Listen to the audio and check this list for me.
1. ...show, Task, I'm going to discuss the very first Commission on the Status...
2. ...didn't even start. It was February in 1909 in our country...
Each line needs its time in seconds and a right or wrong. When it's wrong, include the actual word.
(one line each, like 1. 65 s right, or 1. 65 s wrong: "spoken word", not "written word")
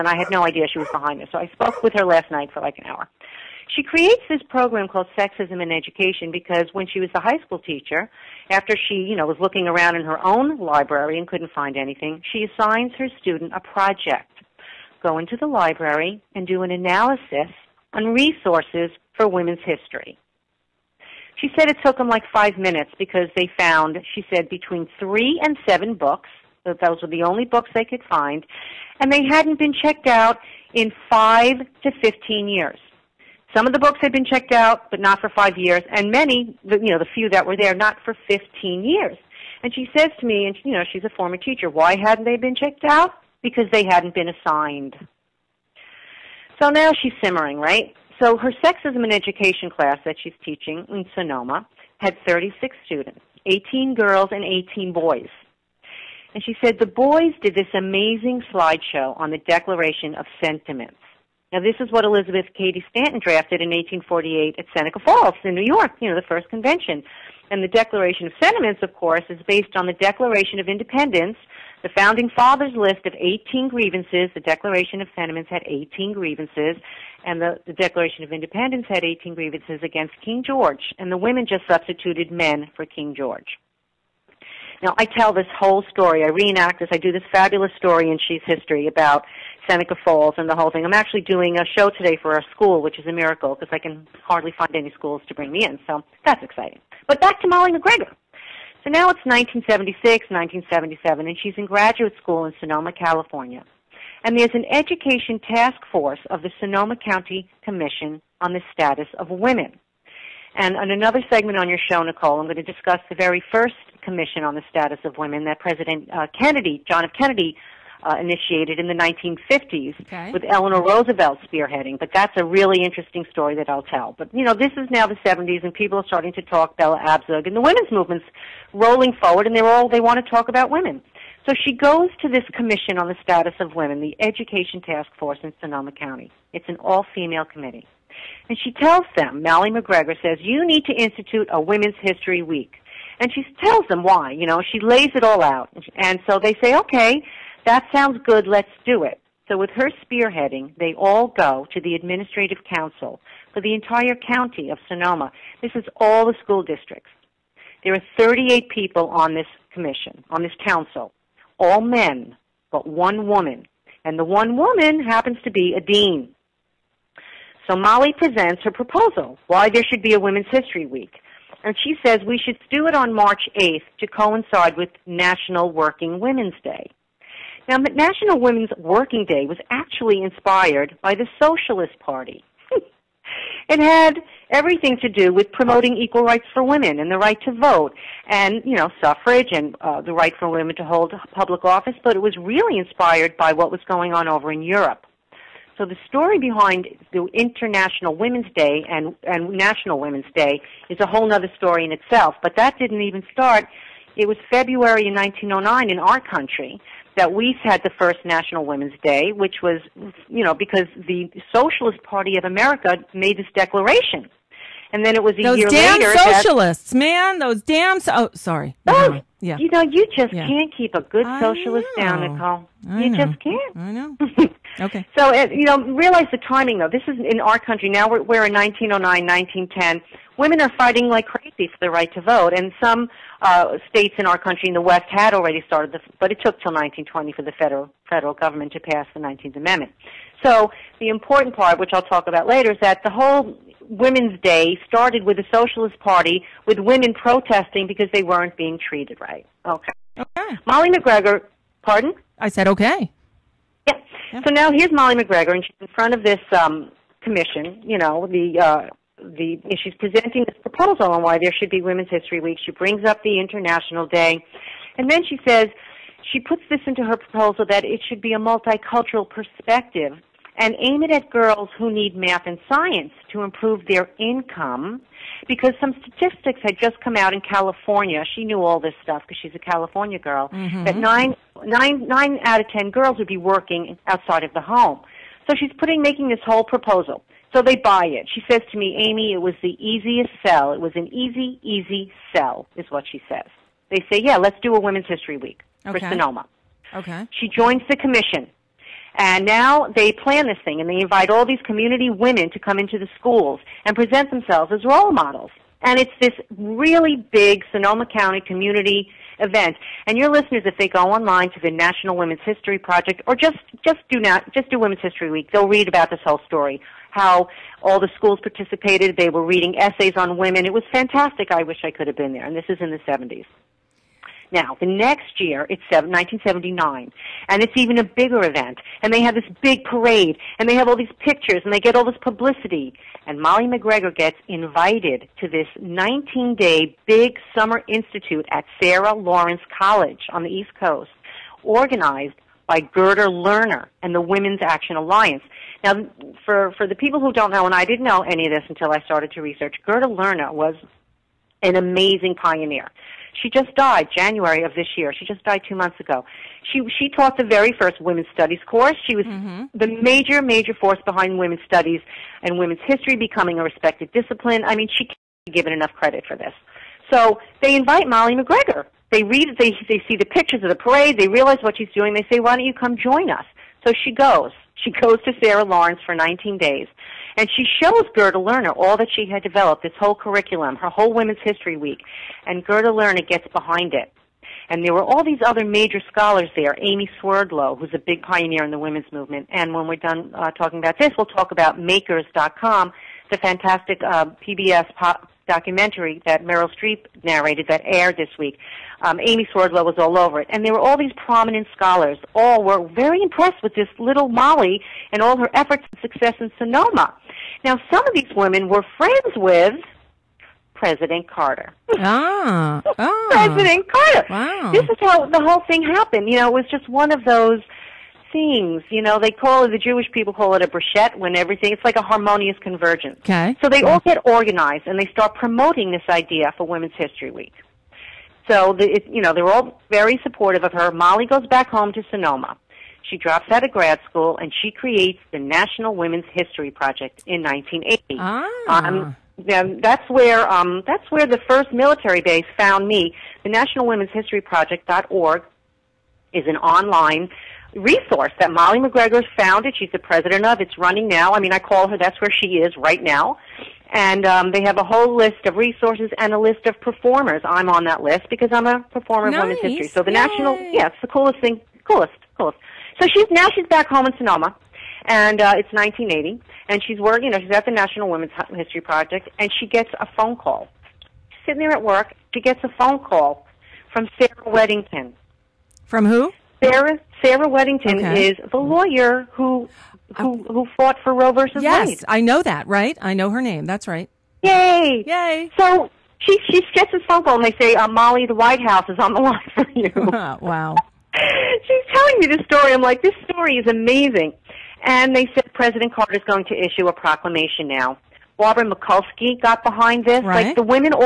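1. 111 s wrong: "Nicole", not "Task"
2. 202 s right.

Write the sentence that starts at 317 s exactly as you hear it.
How all the schools participated, they were reading essays on women.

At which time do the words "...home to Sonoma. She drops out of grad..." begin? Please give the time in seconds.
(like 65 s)
431 s.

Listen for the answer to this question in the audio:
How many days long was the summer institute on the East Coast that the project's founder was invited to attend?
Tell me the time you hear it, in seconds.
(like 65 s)
335 s.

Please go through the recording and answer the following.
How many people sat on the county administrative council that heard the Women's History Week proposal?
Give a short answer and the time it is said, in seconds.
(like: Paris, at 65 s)
38, at 158 s.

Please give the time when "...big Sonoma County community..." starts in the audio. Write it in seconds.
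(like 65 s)
307 s.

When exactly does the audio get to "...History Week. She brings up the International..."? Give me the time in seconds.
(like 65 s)
262 s.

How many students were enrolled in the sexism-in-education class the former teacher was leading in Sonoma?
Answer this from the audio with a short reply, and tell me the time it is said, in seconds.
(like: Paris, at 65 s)
36, at 52 s.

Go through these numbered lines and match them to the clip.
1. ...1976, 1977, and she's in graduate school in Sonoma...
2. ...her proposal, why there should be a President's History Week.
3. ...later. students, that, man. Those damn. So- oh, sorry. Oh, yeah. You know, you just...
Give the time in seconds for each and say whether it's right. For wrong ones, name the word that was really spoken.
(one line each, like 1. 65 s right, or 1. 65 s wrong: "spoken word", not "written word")
1. 99 s right
2. 168 s wrong: "Women", not "President"
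3. 215 s wrong: "socialists", not "students".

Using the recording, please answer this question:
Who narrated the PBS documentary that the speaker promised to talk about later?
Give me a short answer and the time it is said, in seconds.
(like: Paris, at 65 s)
Meryl Streep, at 396 s.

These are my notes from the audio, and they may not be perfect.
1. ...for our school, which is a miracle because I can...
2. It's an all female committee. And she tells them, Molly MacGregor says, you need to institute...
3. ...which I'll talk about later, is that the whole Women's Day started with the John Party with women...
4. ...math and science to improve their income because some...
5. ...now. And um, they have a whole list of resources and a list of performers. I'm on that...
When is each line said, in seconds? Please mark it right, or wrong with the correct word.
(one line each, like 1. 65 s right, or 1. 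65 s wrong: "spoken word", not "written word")
1. 92 s right
2. 136 s right
3. 241 s wrong: "Socialist", not "John"
4. 272 s right
5. 453 s right.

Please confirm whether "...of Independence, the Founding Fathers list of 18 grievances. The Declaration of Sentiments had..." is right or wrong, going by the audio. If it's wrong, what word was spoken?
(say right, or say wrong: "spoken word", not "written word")
right.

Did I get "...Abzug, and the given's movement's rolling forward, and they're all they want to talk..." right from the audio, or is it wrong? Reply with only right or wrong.
wrong.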